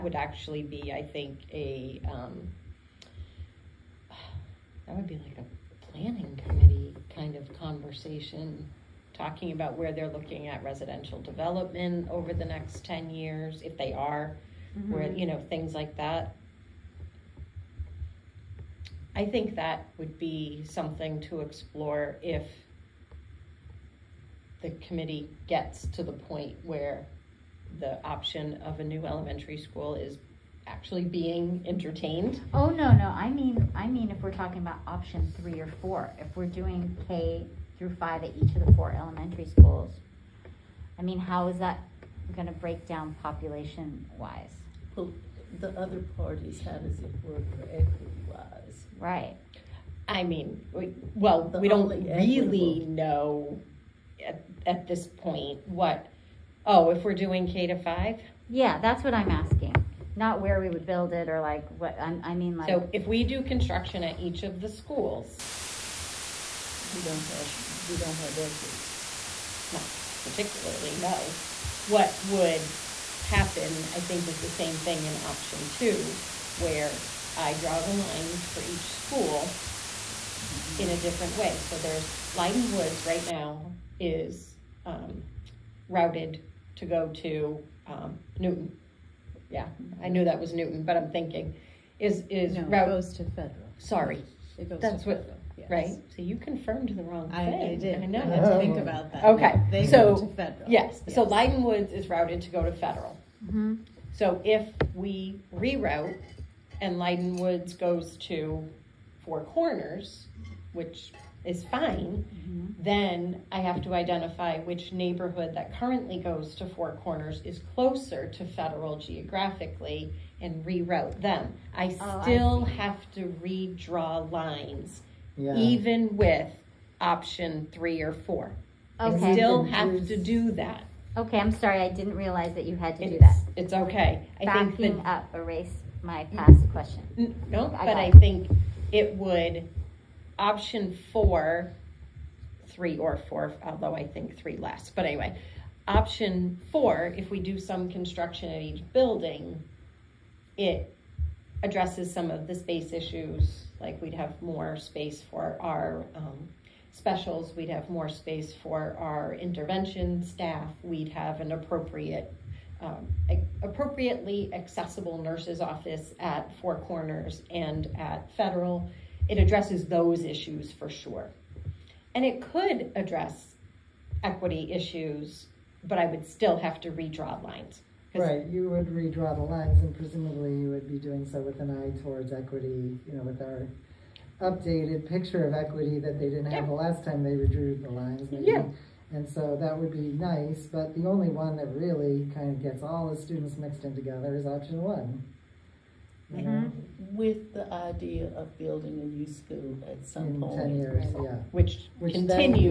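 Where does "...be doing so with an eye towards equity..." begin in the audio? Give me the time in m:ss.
3:00.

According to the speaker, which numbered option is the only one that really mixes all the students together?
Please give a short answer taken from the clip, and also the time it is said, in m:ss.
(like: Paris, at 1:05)
option 1, at 3:14.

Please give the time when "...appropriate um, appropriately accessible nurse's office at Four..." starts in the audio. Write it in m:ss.
2:41.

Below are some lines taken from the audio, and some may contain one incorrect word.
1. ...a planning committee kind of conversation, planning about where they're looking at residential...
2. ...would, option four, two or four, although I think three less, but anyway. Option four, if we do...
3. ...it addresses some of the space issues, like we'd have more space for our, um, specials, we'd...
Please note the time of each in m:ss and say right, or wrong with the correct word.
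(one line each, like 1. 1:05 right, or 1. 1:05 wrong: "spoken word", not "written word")
1. 0:05 wrong: "talking", not "planning"
2. 2:19 wrong: "three", not "two"
3. 2:30 right.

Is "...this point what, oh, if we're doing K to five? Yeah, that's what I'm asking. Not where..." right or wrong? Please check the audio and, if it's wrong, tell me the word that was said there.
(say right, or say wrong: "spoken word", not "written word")
right.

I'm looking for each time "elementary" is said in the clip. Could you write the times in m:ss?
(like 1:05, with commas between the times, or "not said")
0:29, 0:38.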